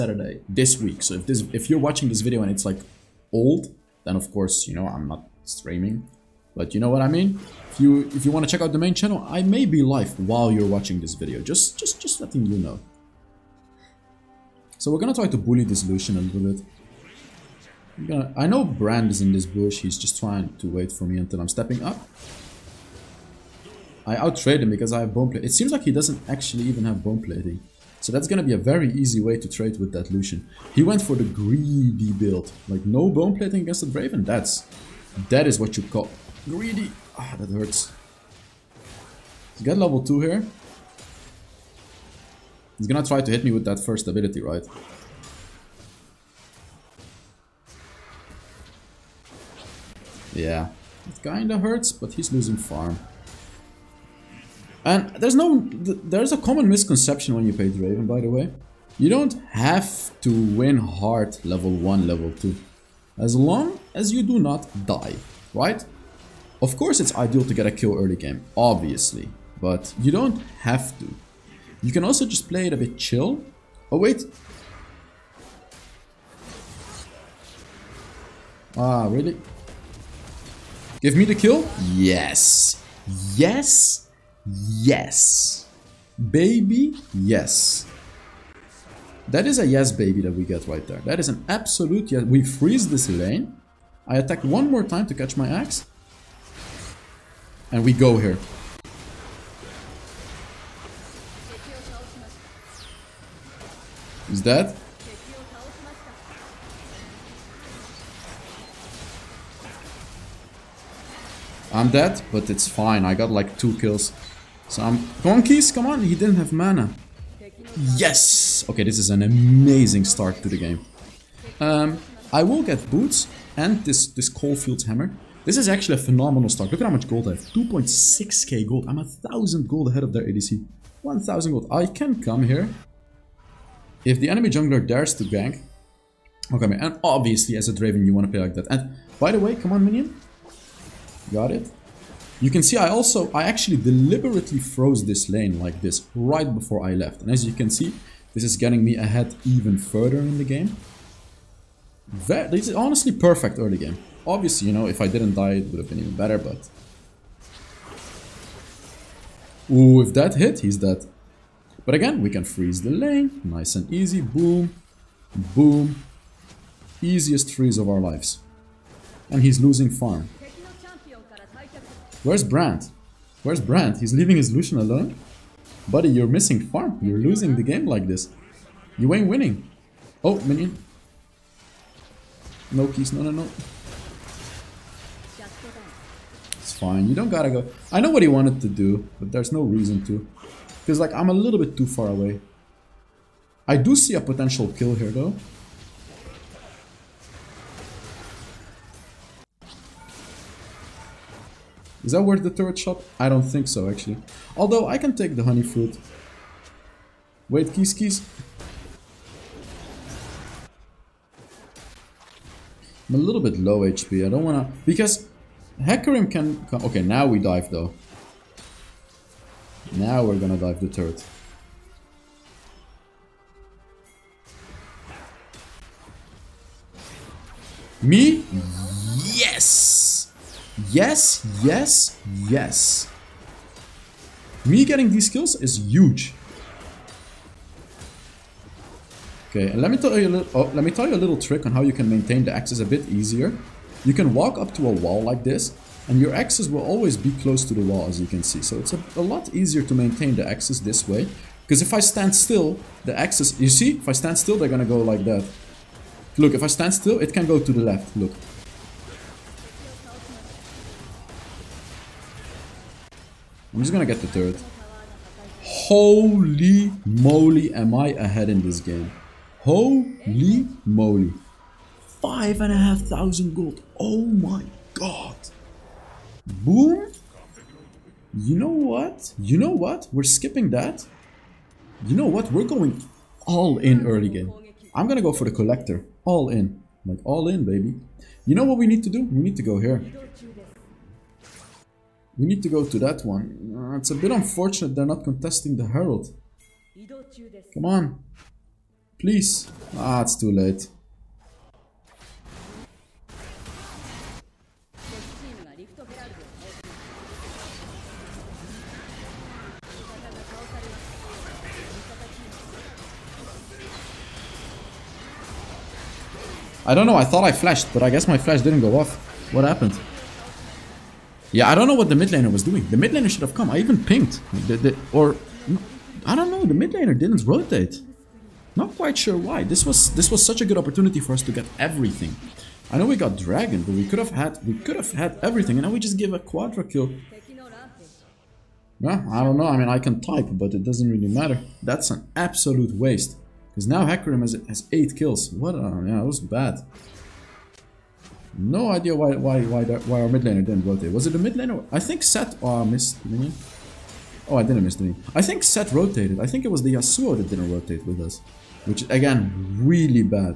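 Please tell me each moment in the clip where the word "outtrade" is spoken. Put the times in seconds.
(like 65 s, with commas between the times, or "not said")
24 s.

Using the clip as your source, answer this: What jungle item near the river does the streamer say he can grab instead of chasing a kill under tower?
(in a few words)
Honey fruit.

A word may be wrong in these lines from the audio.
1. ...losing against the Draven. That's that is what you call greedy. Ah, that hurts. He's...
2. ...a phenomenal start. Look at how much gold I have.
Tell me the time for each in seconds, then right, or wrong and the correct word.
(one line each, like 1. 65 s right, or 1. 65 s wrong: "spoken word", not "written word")
1. 33 s wrong: "plating", not "losing"
2. 125 s right.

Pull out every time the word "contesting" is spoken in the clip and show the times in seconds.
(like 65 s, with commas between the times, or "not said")
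295 s.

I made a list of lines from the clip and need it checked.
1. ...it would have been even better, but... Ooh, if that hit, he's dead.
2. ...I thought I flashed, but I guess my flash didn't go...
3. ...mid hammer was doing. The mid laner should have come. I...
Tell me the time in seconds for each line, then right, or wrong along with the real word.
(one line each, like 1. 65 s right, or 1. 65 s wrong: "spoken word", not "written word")
1. 155 s right
2. 317 s right
3. 322 s wrong: "laner", not "hammer".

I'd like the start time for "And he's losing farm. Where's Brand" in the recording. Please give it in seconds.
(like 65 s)
169 s.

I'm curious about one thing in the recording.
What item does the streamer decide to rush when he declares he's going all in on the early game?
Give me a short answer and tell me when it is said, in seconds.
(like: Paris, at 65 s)
Collector, at 285 s.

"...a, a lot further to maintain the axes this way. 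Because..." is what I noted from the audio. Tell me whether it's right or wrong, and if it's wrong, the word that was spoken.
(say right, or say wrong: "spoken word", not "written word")
wrong: "easier", not "further".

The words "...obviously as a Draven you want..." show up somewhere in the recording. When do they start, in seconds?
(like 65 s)
137 s.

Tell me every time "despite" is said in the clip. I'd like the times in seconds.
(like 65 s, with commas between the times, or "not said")
not said.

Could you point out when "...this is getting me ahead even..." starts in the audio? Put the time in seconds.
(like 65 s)
148 s.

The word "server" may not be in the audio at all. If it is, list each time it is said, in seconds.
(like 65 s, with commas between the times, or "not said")
not said.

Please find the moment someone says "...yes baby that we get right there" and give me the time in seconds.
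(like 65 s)
89 s.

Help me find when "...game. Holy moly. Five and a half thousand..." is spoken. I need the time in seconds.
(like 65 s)
268 s.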